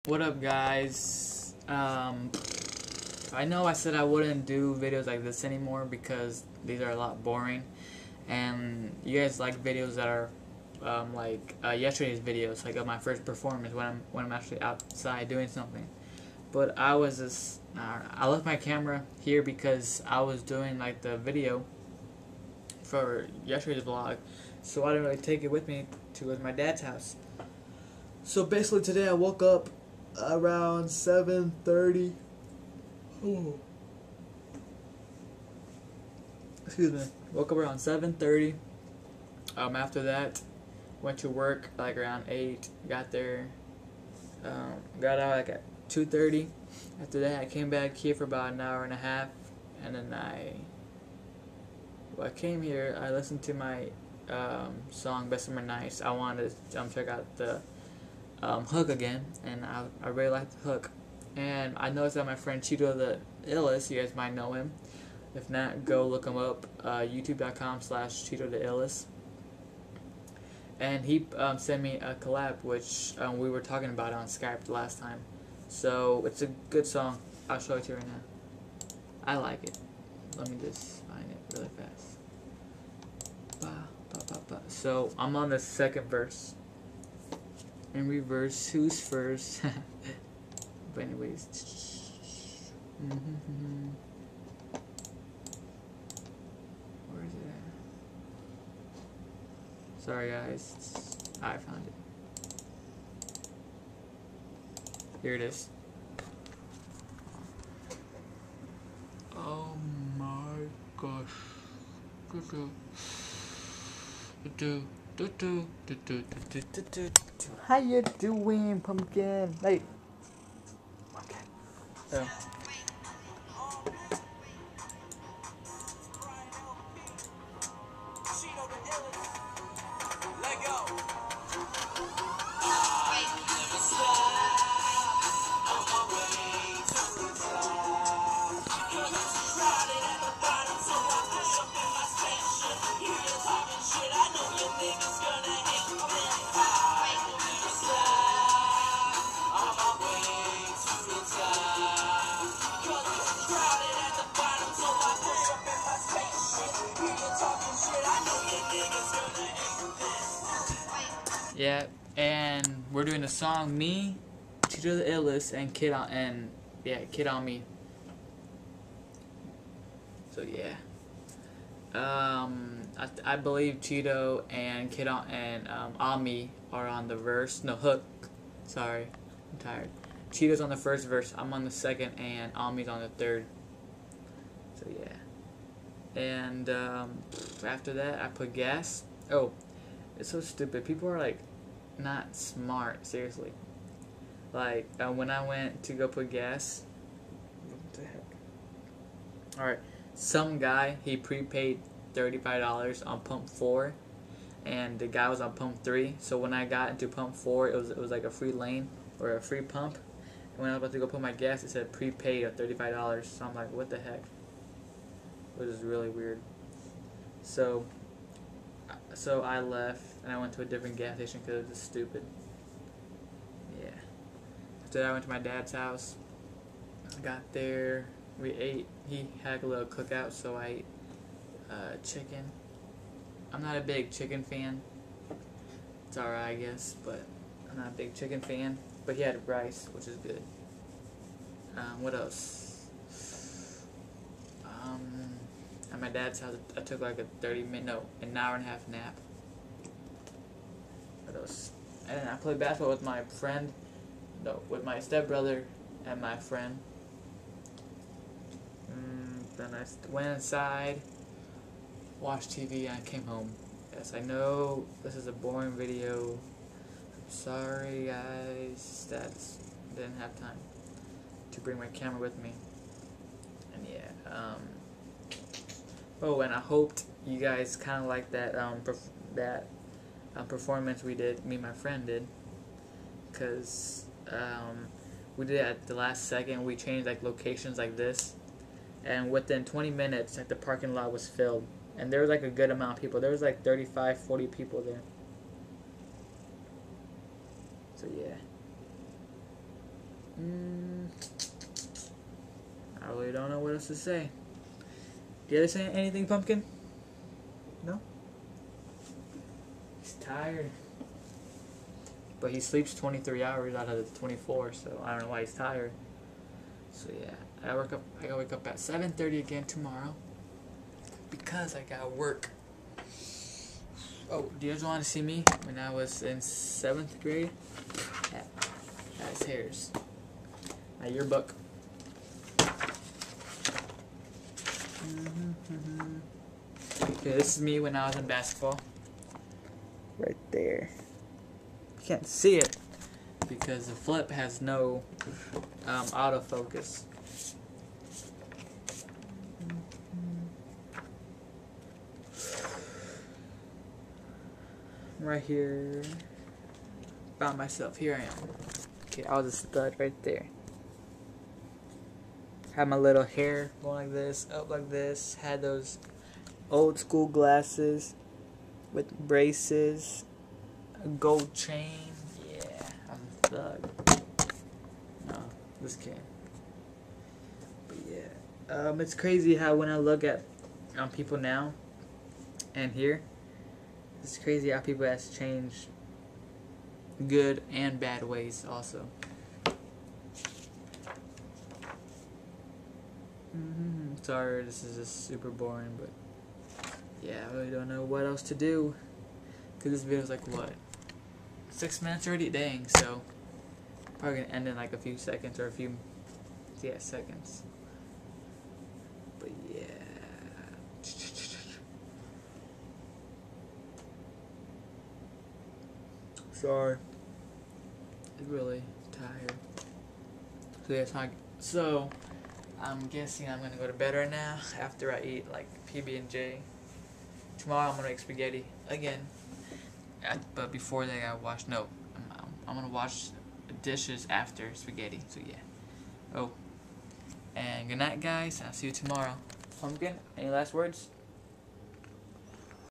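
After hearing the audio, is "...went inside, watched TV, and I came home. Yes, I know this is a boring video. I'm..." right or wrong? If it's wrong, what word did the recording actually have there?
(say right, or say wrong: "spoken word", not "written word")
right.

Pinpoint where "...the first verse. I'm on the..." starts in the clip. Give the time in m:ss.
3:00.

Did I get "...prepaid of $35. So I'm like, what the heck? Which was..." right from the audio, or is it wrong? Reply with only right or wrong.
right.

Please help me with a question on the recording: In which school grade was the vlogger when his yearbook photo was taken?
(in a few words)
seventh grade.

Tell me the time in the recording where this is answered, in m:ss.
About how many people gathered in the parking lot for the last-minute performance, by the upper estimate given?
4:54.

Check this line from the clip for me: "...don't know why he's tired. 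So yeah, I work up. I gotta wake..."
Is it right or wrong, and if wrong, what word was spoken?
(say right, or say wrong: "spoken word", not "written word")
right.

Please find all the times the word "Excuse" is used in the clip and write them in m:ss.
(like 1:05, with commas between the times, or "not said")
0:36.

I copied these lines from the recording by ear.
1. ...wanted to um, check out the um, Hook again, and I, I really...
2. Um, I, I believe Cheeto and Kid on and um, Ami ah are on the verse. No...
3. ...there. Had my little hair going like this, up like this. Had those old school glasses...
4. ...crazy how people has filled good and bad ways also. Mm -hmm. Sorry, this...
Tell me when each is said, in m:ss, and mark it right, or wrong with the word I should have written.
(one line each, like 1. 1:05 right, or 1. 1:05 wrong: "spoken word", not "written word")
1. 0:56 right
2. 2:51 right
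3. 6:00 right
4. 6:24 wrong: "changed", not "filled".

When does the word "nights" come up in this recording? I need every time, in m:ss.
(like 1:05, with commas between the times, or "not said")
0:55, 7:17.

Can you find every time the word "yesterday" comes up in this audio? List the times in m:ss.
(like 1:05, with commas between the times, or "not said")
0:11, 0:23.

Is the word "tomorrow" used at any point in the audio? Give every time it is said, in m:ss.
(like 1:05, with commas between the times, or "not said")
5:19, 7:07, 7:18.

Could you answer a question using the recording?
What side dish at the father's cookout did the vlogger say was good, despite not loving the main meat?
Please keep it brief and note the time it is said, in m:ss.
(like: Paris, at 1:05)
rice, at 3:59.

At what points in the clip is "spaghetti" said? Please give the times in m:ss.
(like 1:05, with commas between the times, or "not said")
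7:08, 7:14.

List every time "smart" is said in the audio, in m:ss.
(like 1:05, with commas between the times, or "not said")
3:12.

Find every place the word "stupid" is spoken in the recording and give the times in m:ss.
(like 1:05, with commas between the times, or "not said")
3:10, 3:41.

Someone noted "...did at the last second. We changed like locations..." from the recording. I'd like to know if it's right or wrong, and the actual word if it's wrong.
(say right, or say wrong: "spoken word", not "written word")
right.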